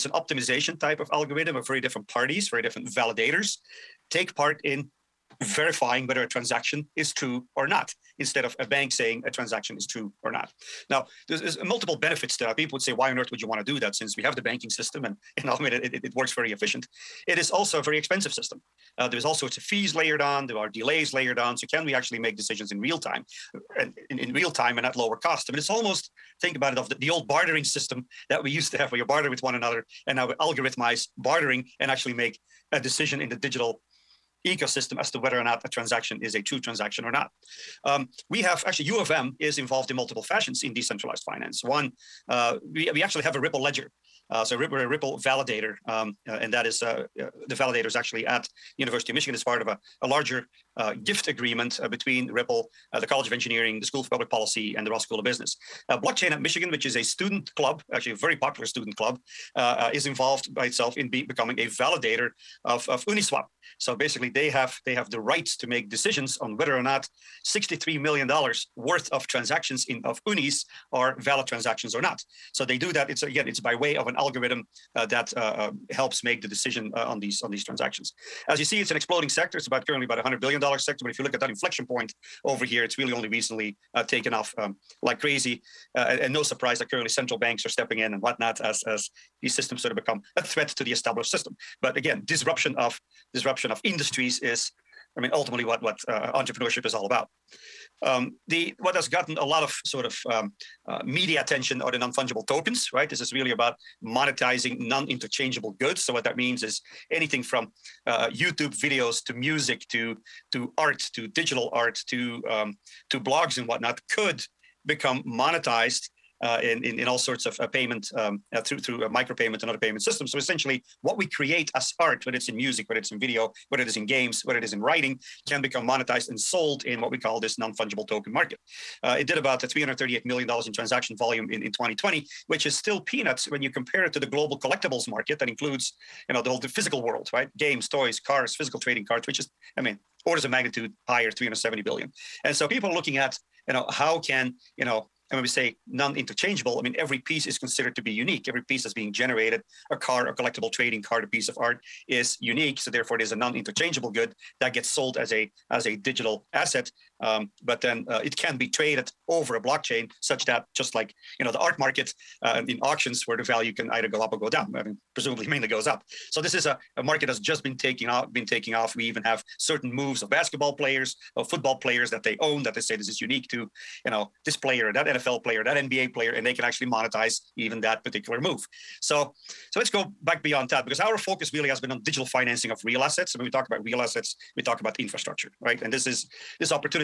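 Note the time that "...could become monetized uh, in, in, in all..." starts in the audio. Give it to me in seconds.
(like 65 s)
114 s.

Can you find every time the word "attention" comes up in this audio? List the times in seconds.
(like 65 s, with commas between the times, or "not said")
101 s.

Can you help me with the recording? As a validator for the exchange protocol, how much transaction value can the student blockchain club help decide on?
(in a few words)
$63 million.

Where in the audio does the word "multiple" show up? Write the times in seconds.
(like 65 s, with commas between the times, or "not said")
11 s, 39 s.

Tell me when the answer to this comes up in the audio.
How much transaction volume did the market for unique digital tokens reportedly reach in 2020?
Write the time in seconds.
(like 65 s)
129 s.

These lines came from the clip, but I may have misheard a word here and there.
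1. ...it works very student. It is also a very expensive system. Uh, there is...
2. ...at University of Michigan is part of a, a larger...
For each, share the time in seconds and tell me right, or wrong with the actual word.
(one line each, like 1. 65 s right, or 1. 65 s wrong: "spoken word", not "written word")
1. 16 s wrong: "efficient", not "student"
2. 48 s right.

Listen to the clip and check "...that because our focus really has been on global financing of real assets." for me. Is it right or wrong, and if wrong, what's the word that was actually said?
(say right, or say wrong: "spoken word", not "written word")
wrong: "digital", not "global".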